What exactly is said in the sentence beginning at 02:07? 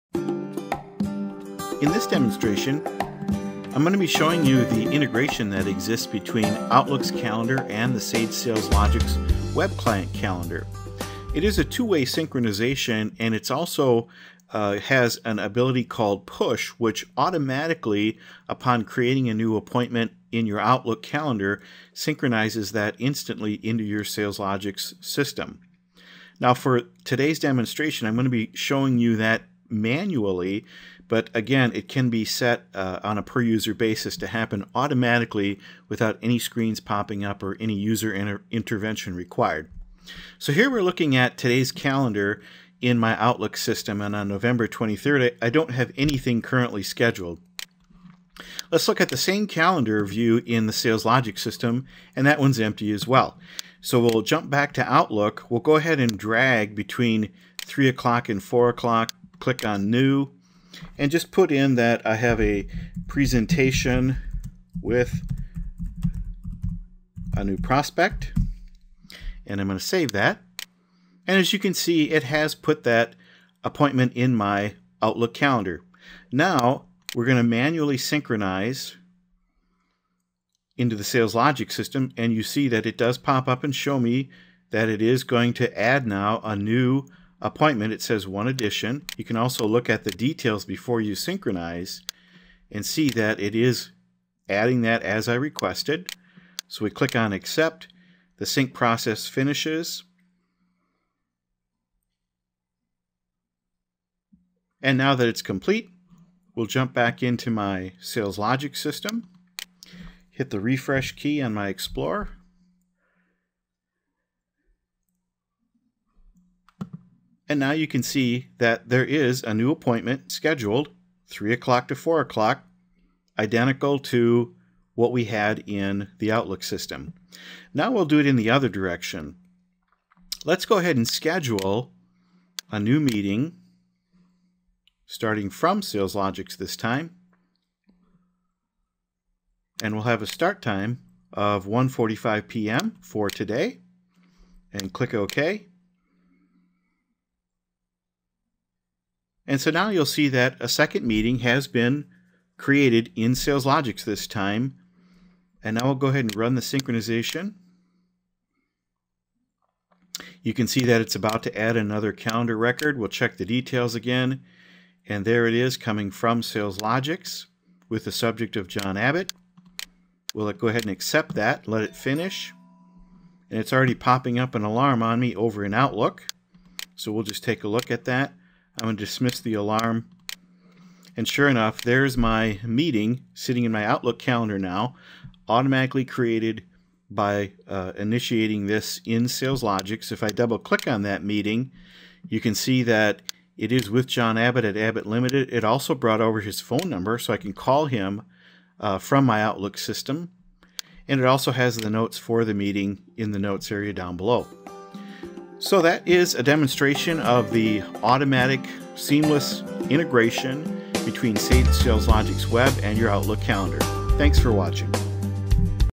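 Now we'll do it in the other direction.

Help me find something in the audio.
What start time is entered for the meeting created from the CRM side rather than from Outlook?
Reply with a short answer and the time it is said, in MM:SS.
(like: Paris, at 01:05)
1:45 p.m., at 02:21.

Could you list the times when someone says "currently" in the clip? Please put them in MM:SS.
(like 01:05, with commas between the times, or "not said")
00:46.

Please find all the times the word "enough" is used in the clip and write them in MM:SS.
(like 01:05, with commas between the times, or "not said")
03:01.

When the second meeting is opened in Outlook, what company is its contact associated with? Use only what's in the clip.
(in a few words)
Abbott Limited.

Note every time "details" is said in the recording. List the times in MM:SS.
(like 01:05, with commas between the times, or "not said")
01:30, 02:43.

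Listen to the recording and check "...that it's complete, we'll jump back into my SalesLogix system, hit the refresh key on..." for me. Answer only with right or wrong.
right.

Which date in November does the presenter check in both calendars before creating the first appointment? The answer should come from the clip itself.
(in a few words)
November 23rd.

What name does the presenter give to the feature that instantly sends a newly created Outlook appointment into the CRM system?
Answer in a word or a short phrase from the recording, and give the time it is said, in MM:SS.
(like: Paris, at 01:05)
push, at 00:16.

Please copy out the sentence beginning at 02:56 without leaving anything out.
So we'll just take a look at that.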